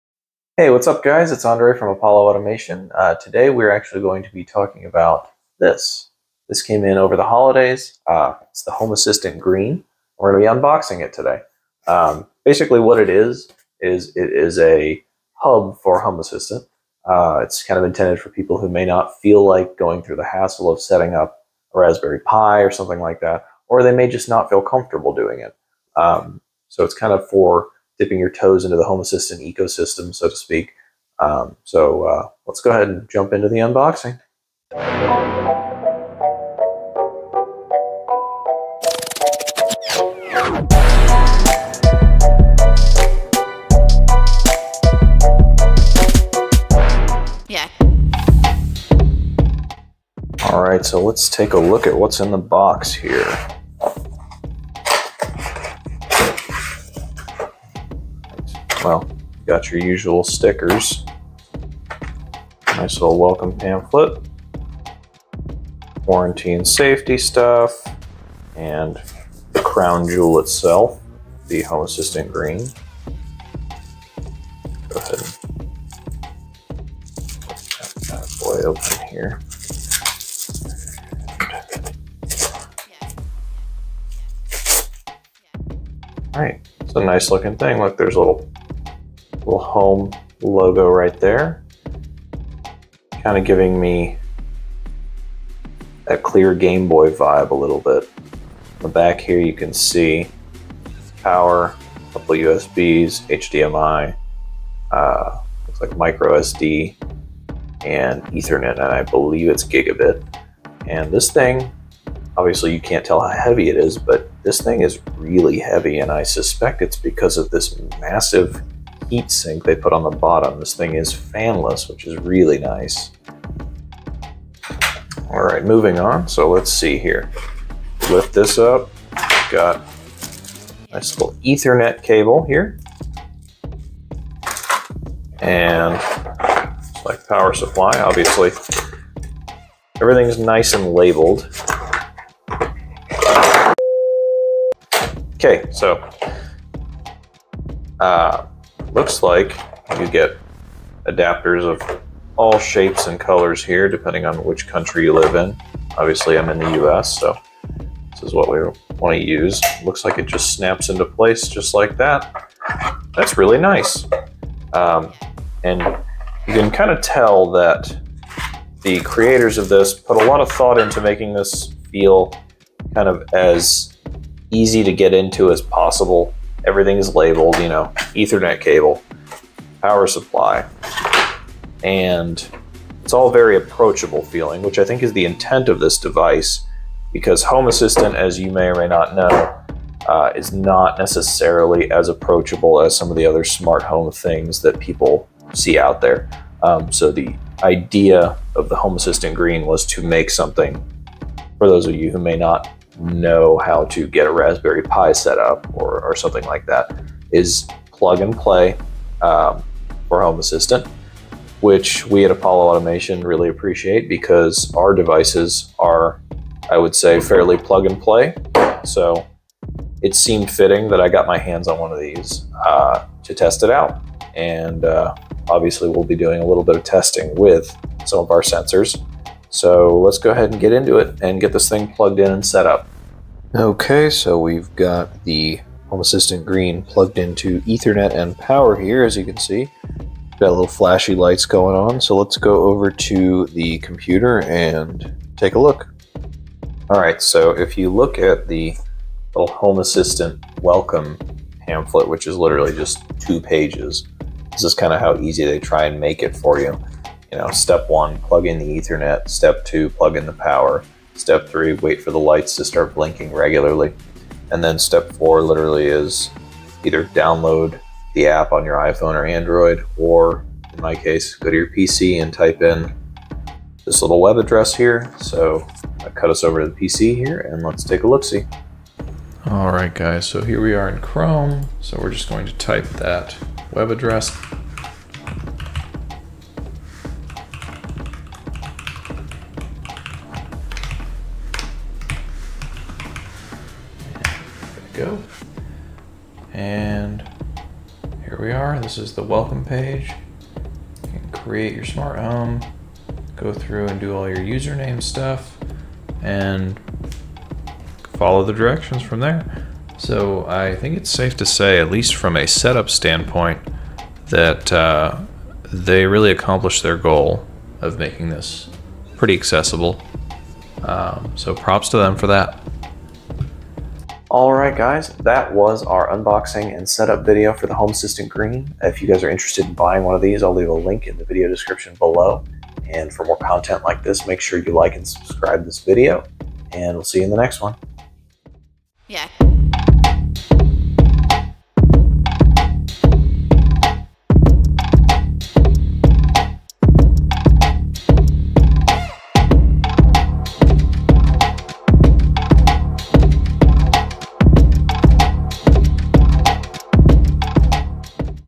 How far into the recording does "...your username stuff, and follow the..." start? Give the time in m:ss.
5:04.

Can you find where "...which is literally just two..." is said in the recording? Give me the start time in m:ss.
4:12.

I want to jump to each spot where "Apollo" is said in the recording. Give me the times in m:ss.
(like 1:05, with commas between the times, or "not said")
0:01, 3:32.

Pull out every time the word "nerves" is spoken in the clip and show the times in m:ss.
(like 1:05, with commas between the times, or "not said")
not said.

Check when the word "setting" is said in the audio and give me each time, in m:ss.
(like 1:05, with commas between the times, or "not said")
0:20.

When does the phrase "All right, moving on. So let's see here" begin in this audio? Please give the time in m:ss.
2:05.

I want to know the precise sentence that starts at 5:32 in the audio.
And for more content like this, make sure you like and subscribe this video.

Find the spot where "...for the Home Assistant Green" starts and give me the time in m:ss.
5:27.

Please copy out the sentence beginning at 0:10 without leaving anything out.
We're going to be unboxing it today.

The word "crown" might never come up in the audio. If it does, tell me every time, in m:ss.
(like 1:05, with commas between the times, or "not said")
1:09.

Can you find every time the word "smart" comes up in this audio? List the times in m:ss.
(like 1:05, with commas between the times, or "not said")
3:13, 5:01.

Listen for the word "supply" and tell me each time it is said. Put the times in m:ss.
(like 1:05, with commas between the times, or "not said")
2:17, 3:00.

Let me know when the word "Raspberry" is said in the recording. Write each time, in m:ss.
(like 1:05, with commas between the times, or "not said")
0:21, 3:24.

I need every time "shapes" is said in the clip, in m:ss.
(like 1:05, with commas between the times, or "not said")
2:32.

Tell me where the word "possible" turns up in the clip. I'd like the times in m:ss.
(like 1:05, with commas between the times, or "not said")
2:55.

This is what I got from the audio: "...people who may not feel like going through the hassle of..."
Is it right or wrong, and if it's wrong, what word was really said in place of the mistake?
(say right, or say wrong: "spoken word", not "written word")
right.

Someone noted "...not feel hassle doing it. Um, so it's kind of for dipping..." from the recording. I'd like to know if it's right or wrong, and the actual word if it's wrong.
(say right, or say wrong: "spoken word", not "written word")
wrong: "comfortable", not "hassle".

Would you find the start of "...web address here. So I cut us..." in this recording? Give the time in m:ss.
4:34.